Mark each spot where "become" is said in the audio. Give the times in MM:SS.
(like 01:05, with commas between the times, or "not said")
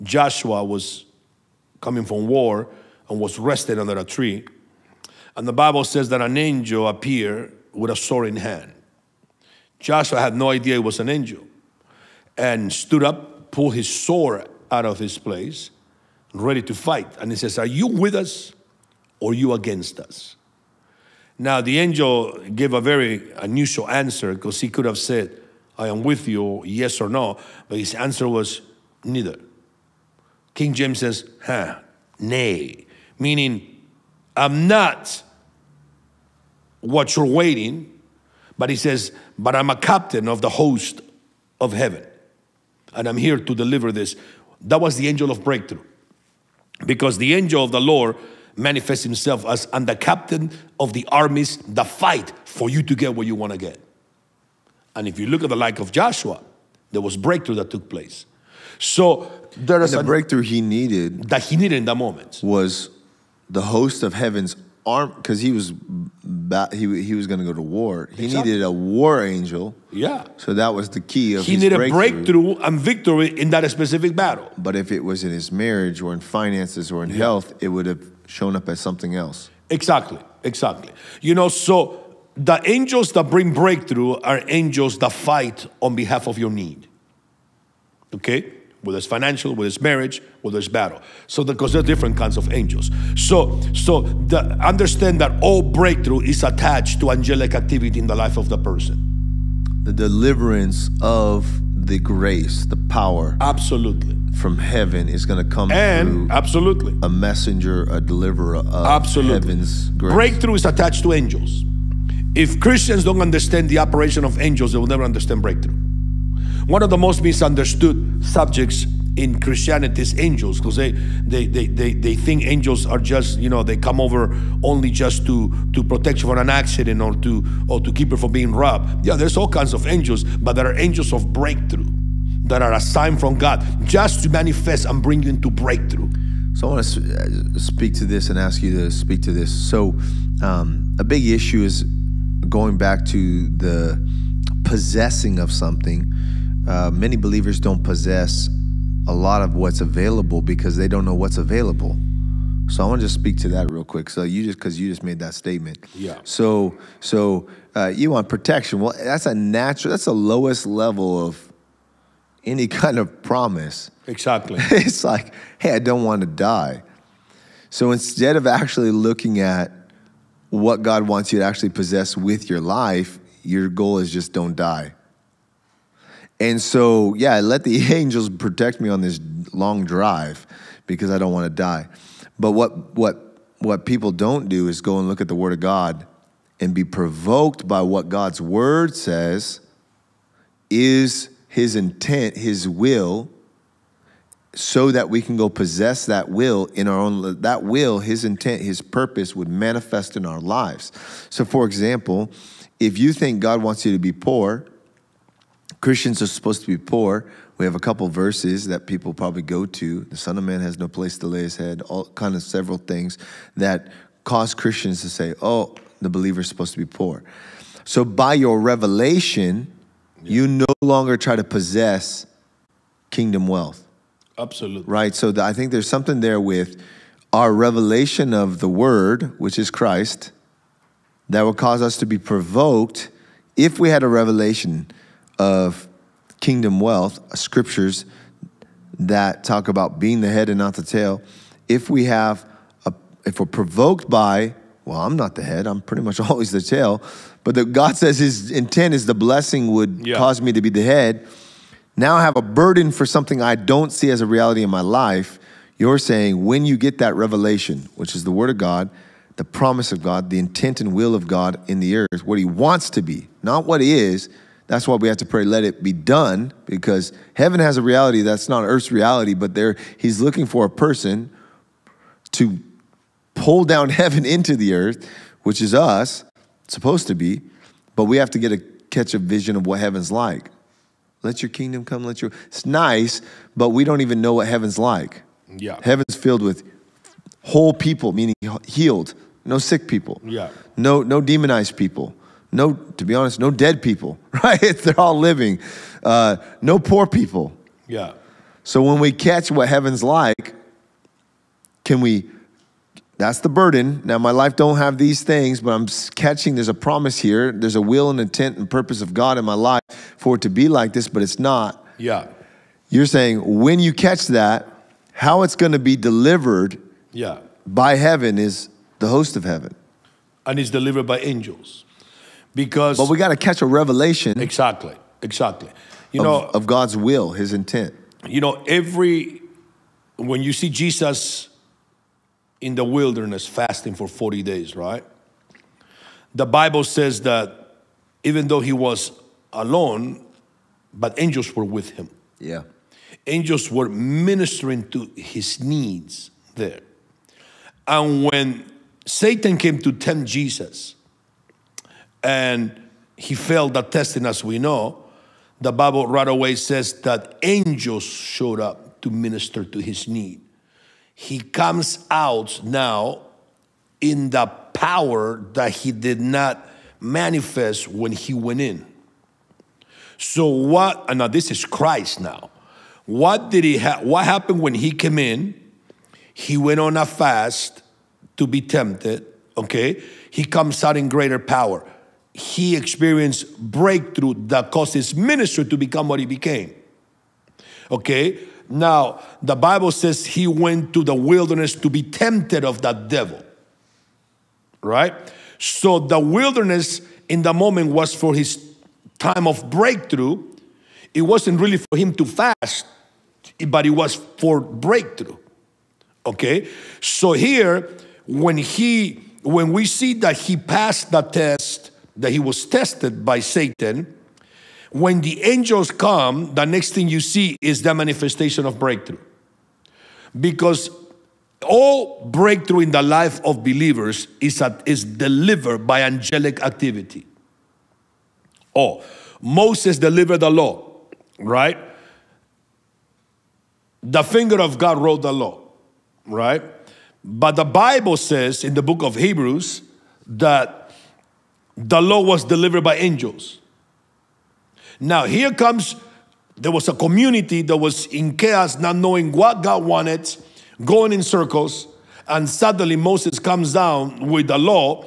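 06:25.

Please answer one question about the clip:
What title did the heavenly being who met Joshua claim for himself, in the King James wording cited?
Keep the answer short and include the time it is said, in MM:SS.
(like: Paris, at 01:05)
Captain of the host of heaven, at 00:39.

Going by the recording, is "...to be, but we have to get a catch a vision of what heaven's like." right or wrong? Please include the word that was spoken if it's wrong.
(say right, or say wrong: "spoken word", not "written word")
right.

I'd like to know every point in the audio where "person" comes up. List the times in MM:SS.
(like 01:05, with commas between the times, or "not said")
01:38, 04:30.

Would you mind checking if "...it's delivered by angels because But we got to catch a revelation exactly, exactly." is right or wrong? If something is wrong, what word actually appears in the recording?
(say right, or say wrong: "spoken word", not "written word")
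right.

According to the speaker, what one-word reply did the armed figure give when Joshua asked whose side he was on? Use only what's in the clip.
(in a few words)
Neither.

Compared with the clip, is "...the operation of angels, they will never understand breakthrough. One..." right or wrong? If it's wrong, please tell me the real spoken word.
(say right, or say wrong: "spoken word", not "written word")
right.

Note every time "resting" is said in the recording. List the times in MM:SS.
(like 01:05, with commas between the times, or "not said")
00:03.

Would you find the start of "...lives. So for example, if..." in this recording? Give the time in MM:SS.
03:20.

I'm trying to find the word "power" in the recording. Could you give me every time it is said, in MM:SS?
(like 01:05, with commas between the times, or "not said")
01:42, 06:04, 06:21.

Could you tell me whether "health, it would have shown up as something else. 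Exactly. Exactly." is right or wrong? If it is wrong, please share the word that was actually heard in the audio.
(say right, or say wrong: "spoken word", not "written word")
right.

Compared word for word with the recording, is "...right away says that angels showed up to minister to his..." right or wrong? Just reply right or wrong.
right.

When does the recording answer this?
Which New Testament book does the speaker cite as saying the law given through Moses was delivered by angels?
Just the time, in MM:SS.
07:19.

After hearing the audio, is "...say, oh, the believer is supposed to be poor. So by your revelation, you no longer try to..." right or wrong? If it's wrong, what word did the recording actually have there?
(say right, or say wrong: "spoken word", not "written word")
right.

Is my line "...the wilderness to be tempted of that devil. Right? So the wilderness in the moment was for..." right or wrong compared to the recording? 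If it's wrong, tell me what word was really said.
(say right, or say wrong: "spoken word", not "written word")
right.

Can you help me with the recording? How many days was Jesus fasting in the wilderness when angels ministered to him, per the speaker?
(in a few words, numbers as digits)
40.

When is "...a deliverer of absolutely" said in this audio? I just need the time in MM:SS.
01:47.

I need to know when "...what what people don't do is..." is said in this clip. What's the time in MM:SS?
03:02.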